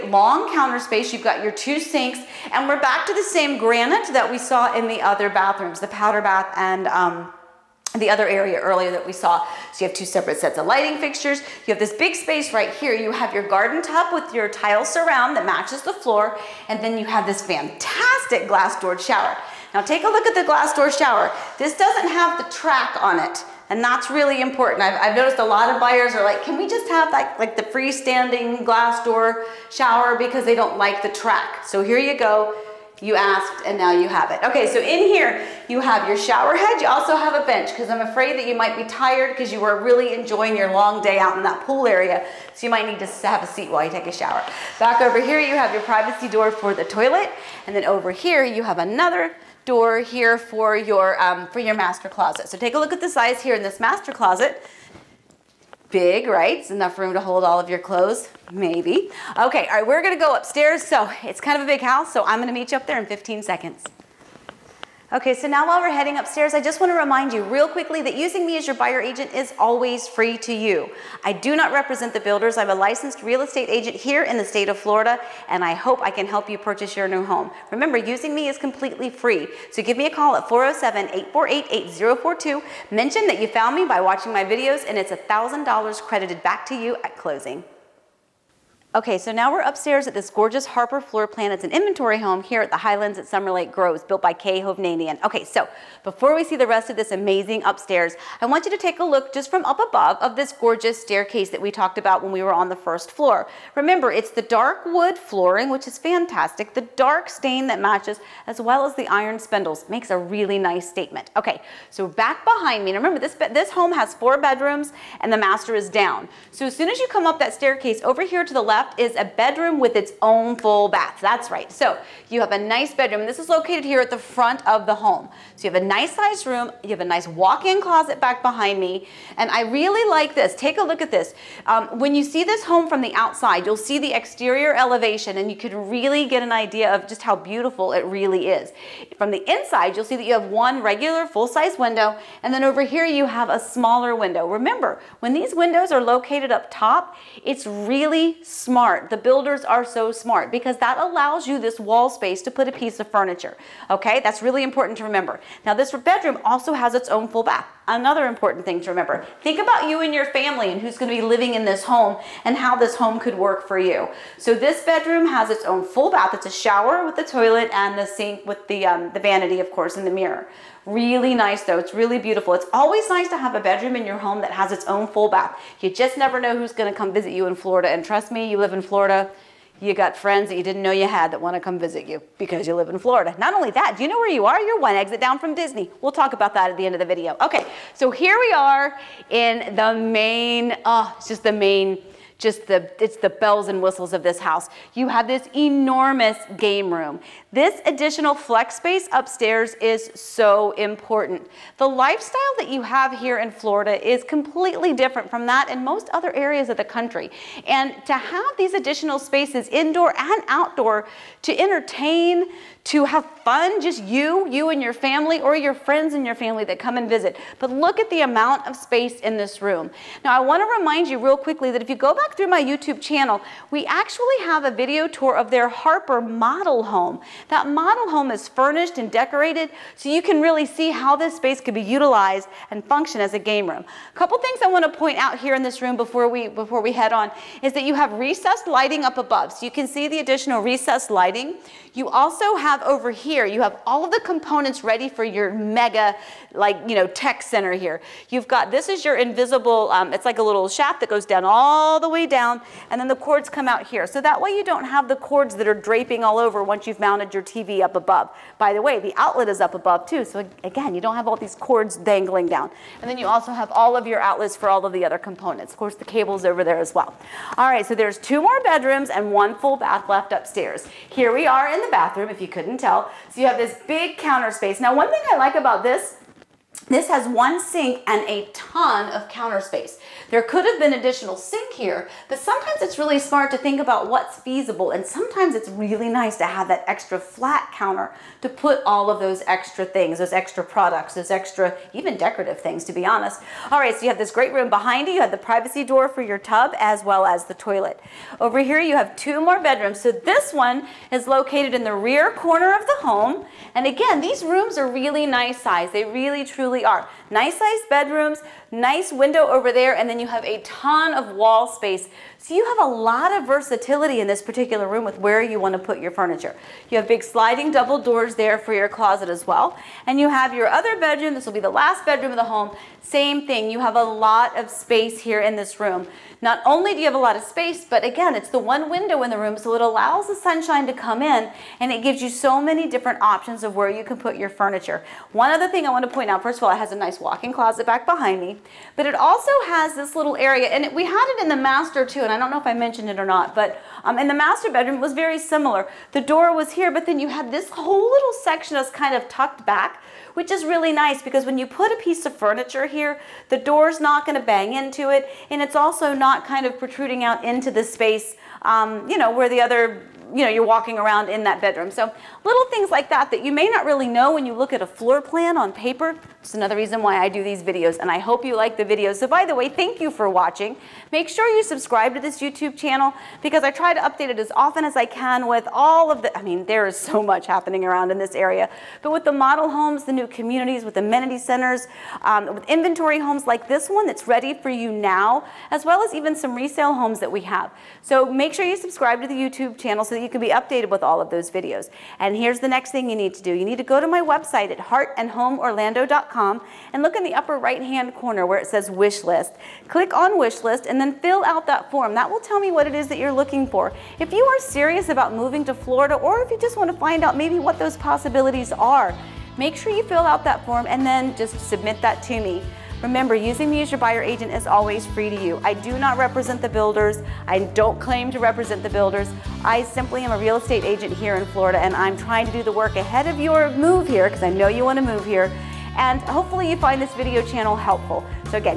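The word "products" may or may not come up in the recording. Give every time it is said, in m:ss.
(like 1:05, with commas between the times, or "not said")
4:50.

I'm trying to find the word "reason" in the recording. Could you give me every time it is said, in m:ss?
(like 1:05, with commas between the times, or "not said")
6:06.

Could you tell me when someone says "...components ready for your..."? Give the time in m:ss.
4:04.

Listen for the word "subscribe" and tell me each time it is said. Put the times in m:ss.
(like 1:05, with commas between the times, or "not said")
6:11, 6:28.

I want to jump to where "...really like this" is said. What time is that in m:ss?
2:09.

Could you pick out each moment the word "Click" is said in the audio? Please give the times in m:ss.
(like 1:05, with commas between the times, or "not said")
6:39.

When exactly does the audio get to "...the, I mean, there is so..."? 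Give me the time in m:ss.
6:16.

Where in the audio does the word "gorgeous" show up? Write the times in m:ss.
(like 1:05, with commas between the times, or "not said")
1:30, 1:40.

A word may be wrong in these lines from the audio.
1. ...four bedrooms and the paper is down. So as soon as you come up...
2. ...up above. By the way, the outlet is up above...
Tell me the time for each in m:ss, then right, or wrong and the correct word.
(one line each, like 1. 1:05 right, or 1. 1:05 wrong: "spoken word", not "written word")
1. 1:54 wrong: "master", not "paper"
2. 4:17 right.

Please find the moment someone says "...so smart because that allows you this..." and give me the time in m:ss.
2:29.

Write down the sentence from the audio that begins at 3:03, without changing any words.
Not only that, do you know where you are?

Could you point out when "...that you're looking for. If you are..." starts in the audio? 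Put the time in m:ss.
6:43.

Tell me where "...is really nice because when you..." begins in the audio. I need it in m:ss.
5:50.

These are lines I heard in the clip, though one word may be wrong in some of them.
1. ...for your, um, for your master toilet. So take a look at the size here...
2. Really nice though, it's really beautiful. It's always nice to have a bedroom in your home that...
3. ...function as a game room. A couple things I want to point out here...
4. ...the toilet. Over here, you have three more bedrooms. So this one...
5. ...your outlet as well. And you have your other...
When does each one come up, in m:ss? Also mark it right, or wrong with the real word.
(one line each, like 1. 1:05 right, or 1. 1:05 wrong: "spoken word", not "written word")
1. 0:50 wrong: "closet", not "toilet"
2. 2:50 right
3. 3:52 right
4. 4:57 wrong: "two", not "three"
5. 5:18 wrong: "closet", not "outlet".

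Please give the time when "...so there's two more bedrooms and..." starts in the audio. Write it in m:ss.
4:27.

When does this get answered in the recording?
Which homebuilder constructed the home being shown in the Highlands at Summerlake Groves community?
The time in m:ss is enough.
1:34.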